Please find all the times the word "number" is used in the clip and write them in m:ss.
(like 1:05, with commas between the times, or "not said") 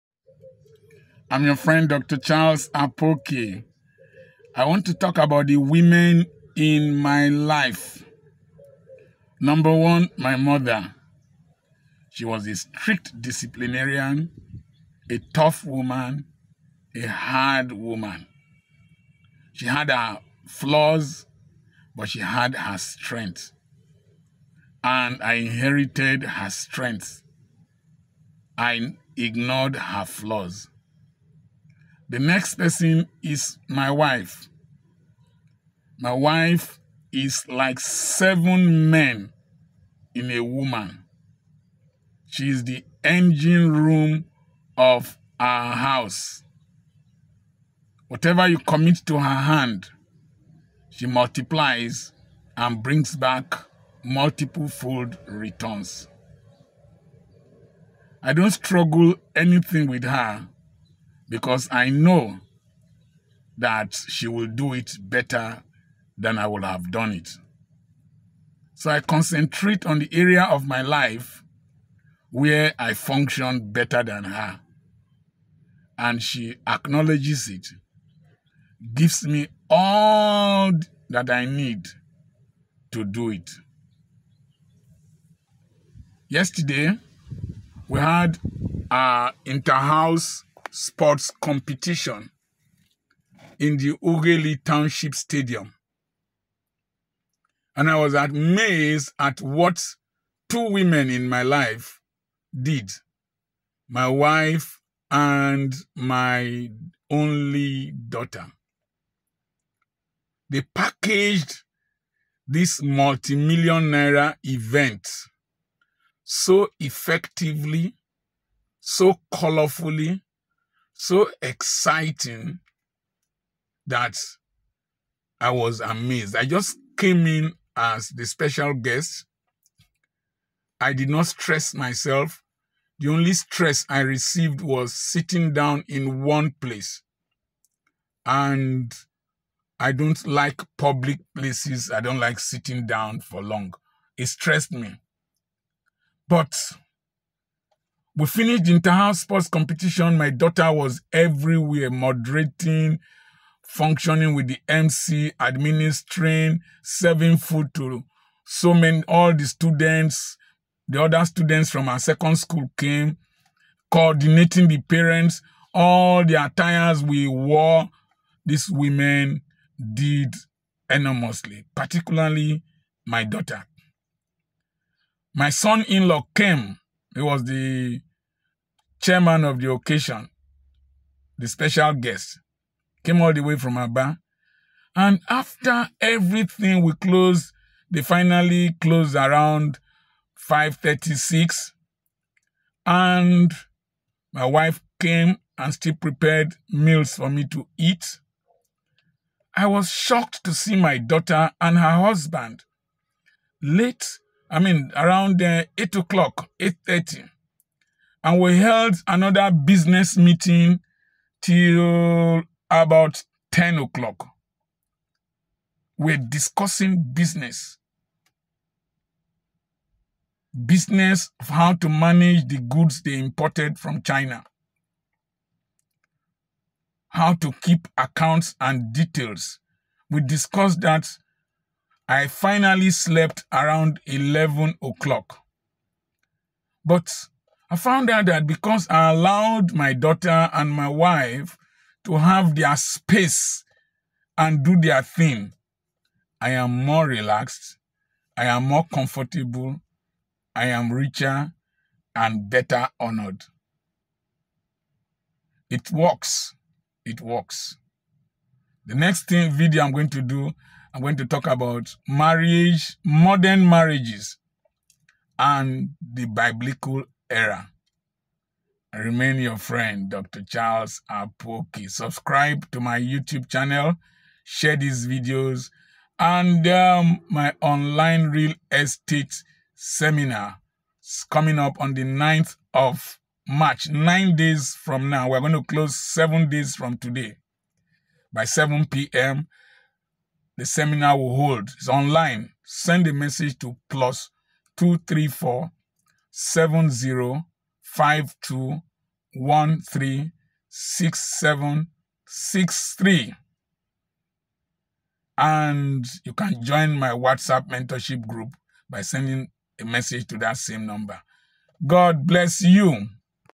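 0:09, 5:10.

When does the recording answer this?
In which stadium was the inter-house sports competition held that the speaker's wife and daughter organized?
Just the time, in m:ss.
1:34.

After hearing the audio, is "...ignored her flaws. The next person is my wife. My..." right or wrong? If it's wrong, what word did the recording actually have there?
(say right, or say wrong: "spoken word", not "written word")
right.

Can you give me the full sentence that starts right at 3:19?
I was shocked to see my daughter and her husband late I mean, around uh, 8 o'clock, 8.30.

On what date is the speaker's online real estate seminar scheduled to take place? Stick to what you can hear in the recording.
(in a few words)
9th of March.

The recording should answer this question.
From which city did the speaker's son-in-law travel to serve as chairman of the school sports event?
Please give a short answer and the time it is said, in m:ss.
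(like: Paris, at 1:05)
Aba, at 3:03.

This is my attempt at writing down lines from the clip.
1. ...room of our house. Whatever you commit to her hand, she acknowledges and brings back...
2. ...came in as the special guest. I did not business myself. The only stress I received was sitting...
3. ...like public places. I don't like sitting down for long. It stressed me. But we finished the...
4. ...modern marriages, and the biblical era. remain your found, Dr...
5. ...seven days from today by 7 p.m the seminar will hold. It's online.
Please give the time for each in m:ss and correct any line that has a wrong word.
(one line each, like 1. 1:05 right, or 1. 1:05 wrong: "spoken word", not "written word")
1. 0:43 wrong: "multiplies", not "acknowledges"
2. 2:06 wrong: "stress", not "business"
3. 2:20 right
4. 4:23 wrong: "friend", not "found"
5. 4:45 right.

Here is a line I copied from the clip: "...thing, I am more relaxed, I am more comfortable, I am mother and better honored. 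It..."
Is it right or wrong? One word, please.
wrong.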